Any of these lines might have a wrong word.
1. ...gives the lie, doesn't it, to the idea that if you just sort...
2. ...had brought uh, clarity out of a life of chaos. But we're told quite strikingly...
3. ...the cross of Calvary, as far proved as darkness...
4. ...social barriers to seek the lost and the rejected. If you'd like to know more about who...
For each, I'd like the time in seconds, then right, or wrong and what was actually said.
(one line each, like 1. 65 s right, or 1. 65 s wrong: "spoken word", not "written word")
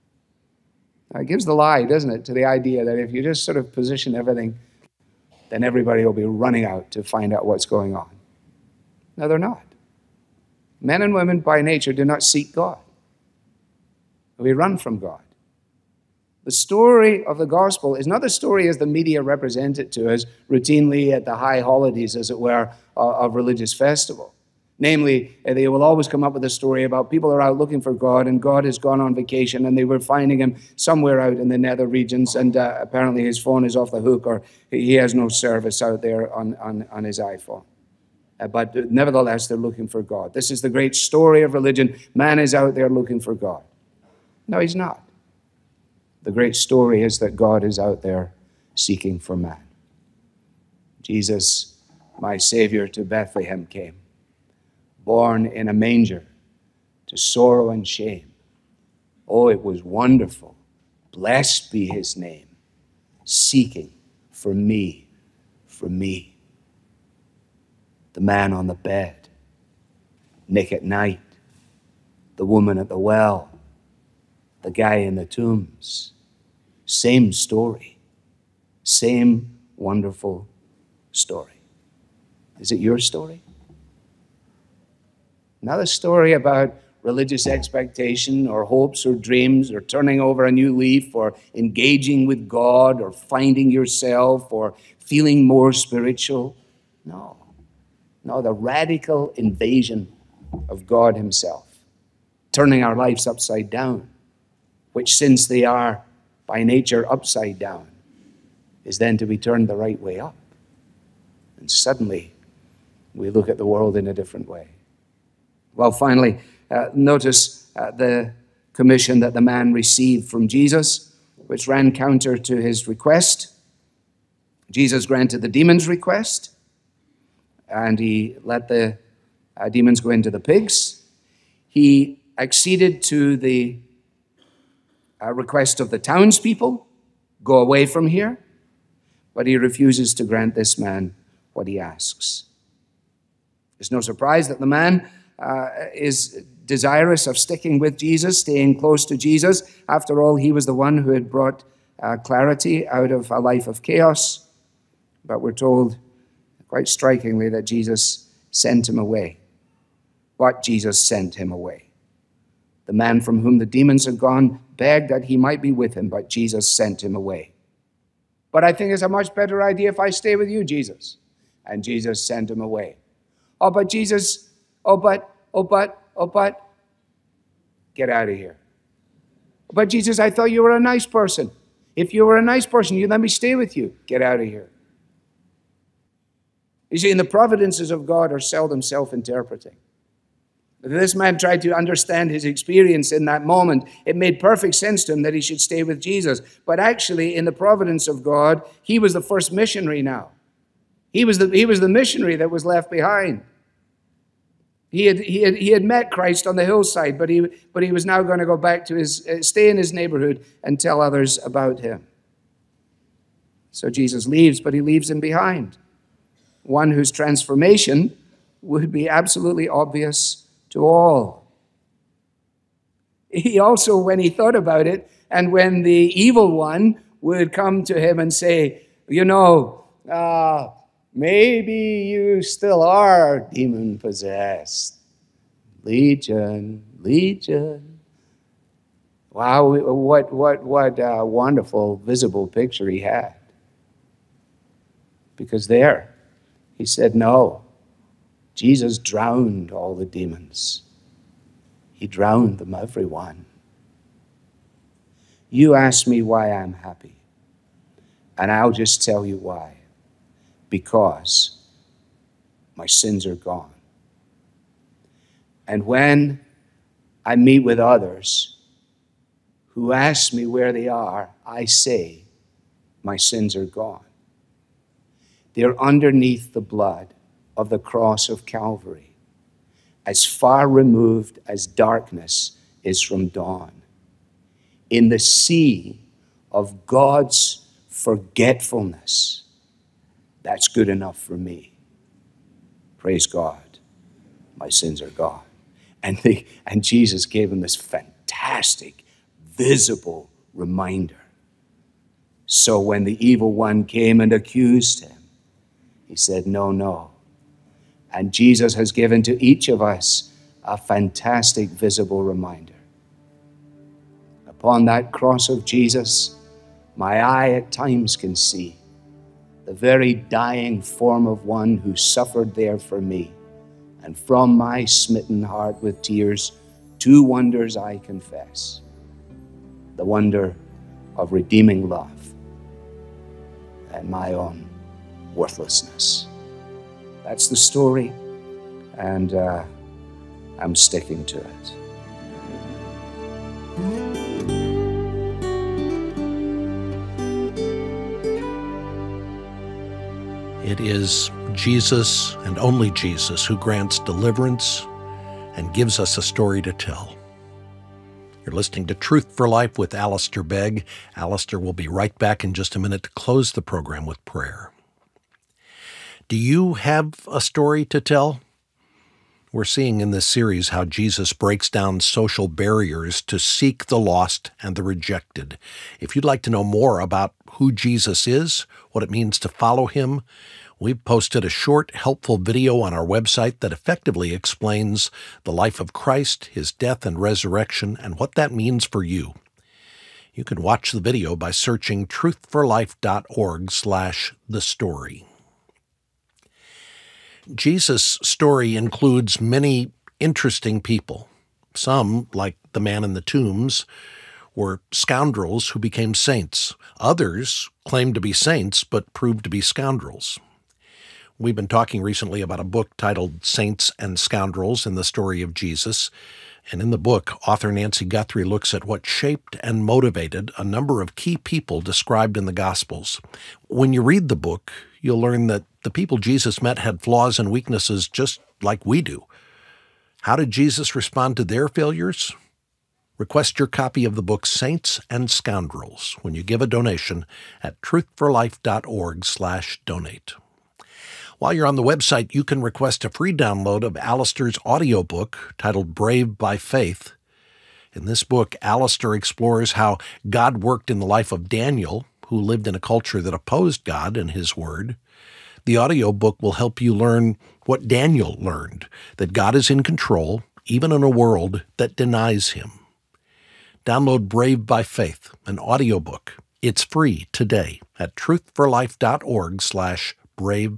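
1. 1 s right
2. 151 s right
3. 277 s wrong: "removed", not "proved"
4. 371 s right.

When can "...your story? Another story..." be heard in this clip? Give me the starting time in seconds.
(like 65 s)
82 s.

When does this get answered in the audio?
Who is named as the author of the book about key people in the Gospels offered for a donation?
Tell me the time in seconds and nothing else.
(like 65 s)
417 s.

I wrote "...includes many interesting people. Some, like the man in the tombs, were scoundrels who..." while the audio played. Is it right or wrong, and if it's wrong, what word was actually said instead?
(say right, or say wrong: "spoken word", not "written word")
right.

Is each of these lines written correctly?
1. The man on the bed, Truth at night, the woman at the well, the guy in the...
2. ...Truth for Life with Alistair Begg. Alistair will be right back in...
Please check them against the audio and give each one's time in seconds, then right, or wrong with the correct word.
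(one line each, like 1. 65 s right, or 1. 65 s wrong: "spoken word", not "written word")
1. 68 s wrong: "Nick", not "Truth"
2. 358 s right.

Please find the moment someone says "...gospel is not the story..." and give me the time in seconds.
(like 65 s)
17 s.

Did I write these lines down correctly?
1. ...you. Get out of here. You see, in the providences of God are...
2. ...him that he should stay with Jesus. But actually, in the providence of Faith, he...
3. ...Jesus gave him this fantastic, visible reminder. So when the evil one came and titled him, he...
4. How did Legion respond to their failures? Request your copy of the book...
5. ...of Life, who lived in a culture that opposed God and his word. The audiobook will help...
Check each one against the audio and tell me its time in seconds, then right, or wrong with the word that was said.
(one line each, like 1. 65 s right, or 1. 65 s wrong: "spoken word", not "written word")
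1. 183 s right
2. 195 s wrong: "God", not "Faith"
3. 296 s wrong: "accused", not "titled"
4. 430 s wrong: "Jesus", not "Legion"
5. 451 s wrong: "Daniel", not "Life".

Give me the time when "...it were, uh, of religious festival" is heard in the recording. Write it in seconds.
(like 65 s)
22 s.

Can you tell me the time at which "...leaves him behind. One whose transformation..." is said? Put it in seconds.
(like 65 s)
214 s.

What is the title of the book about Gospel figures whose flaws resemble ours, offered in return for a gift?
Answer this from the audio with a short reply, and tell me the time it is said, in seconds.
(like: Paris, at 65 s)
Saints and Scoundrels in the Story of Jesus, at 413 s.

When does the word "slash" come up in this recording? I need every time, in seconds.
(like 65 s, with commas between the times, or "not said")
393 s, 469 s.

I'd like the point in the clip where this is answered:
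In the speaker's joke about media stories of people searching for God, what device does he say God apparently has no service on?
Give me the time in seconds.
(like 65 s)
37 s.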